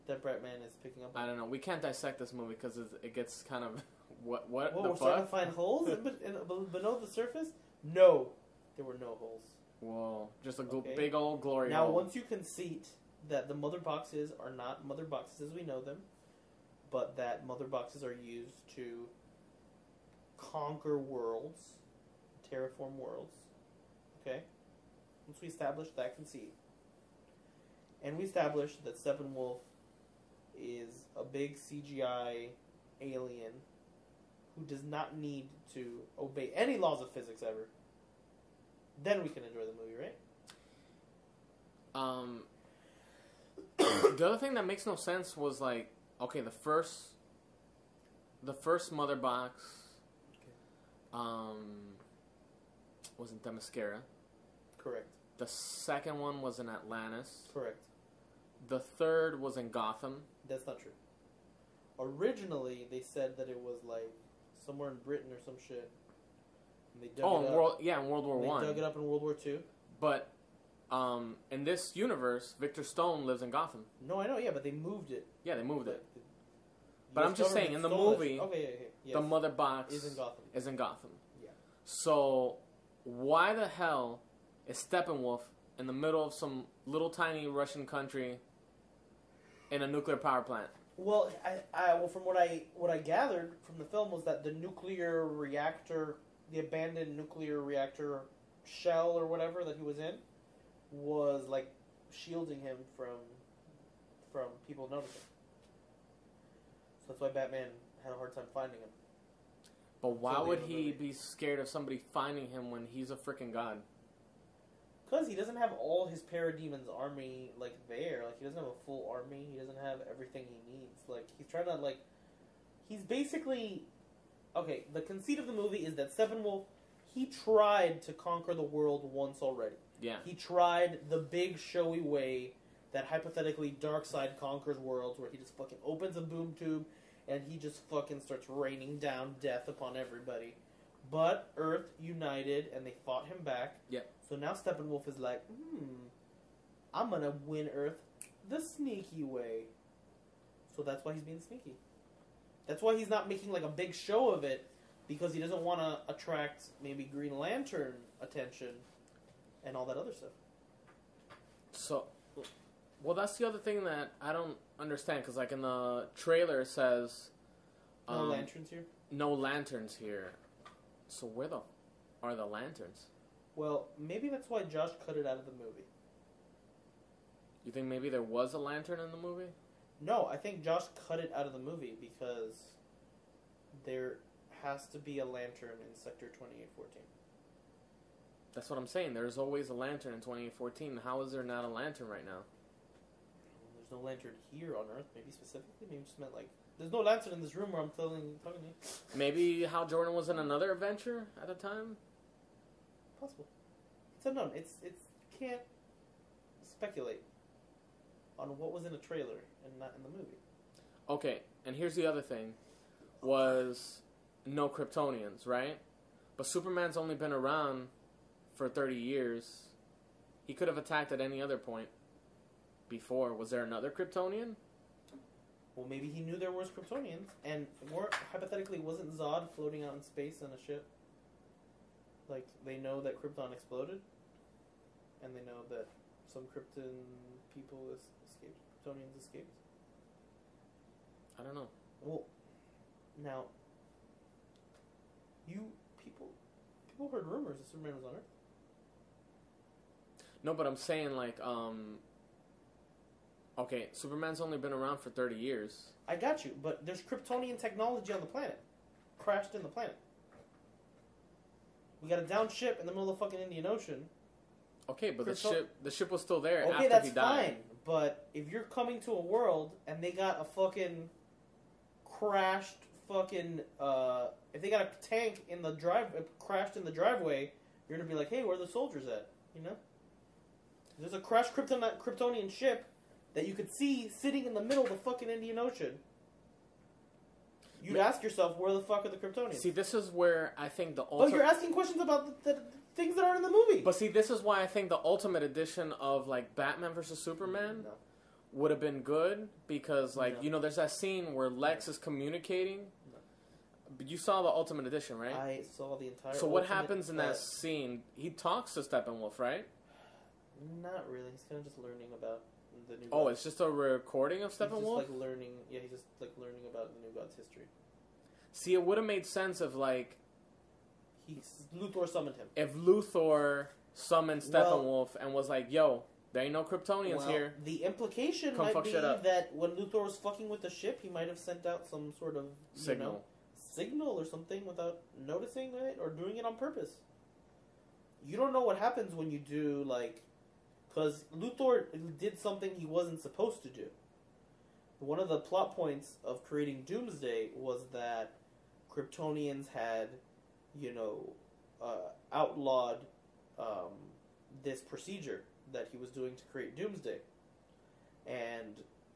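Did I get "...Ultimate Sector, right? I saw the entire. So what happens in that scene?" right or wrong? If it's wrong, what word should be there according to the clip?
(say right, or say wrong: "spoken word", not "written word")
wrong: "Edition", not "Sector".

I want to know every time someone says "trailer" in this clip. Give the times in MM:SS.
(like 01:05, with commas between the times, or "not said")
02:46, 03:28.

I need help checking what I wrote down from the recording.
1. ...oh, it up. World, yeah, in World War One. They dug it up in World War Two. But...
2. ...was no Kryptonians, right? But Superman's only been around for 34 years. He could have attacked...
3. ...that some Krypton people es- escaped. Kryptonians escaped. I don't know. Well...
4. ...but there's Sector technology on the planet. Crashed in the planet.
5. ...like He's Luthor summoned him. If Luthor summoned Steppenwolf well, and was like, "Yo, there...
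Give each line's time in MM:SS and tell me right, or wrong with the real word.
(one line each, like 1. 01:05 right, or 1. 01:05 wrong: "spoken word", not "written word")
1. 01:07 right
2. 03:33 wrong: "30", not "34"
3. 03:55 right
4. 04:16 wrong: "Kryptonian", not "Sector"
5. 05:19 right.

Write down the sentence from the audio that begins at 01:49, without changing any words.
But why would he be scared of somebody finding him when he's a freaking god?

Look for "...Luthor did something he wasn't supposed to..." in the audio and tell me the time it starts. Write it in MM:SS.
05:41.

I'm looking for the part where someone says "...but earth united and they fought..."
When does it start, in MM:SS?
02:21.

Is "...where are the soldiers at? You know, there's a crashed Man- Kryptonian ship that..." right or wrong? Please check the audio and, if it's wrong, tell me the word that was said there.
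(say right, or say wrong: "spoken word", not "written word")
wrong: "Krypton", not "Man".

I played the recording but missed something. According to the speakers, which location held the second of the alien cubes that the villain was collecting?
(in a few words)
Atlantis.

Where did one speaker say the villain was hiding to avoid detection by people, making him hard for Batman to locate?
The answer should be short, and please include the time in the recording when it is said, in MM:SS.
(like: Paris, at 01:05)
abandoned nuclear reactor, at 01:36.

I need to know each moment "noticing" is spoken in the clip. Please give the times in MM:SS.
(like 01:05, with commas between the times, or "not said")
01:44, 05:35.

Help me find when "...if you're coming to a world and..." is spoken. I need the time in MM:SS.
04:28.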